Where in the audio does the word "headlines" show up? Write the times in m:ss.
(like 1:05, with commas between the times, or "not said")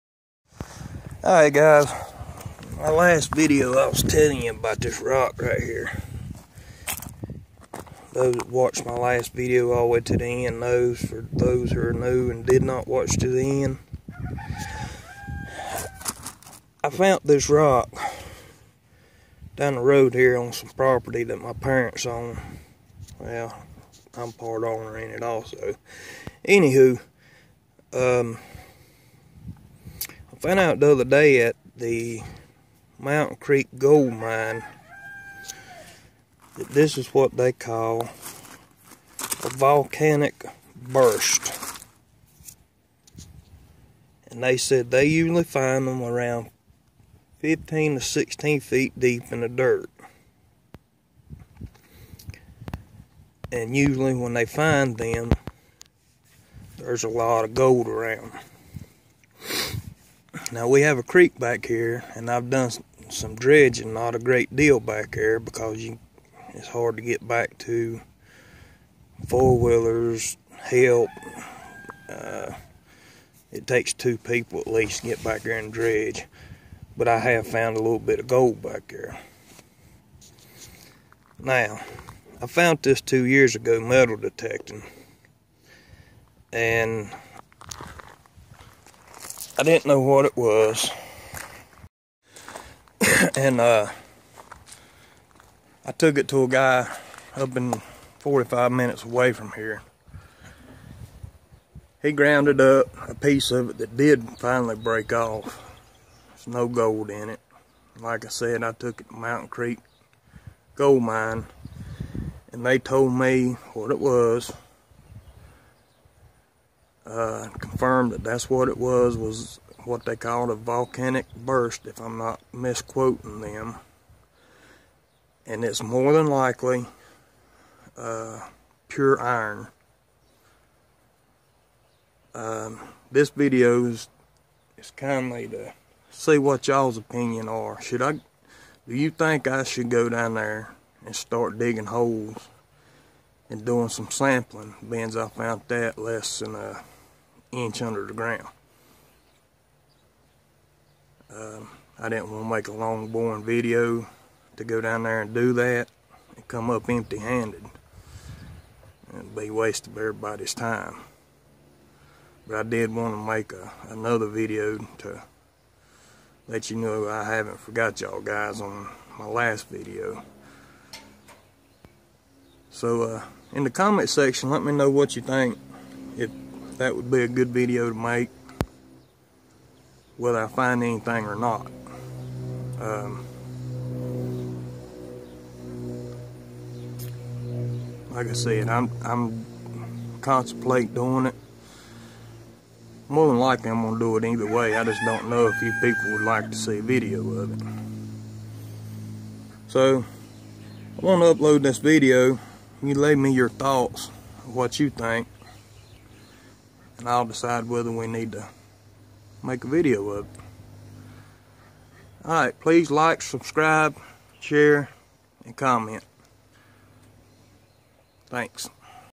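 not said.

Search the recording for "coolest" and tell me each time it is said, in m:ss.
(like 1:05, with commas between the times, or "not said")
not said.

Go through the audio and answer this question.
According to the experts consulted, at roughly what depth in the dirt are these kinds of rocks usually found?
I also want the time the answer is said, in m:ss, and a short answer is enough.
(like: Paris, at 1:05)
15 to 16 feet, at 0:47.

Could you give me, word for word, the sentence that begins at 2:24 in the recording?
Beans I found that less than a inch under the ground.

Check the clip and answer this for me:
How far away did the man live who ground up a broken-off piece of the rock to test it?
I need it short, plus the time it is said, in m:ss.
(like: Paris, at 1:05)
45 minutes, at 1:38.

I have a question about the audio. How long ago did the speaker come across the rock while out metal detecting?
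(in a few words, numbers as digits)
2 years ago.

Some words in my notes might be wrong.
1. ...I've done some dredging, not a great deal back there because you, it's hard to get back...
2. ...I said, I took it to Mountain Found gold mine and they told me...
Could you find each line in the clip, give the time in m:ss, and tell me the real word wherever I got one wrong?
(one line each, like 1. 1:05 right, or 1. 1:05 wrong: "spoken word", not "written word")
1. 1:02 right
2. 1:48 wrong: "Creek", not "Found".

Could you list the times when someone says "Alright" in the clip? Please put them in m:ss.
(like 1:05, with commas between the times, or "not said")
0:01, 3:32.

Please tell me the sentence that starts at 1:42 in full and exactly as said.
He grounded up a piece of it that did finally break off.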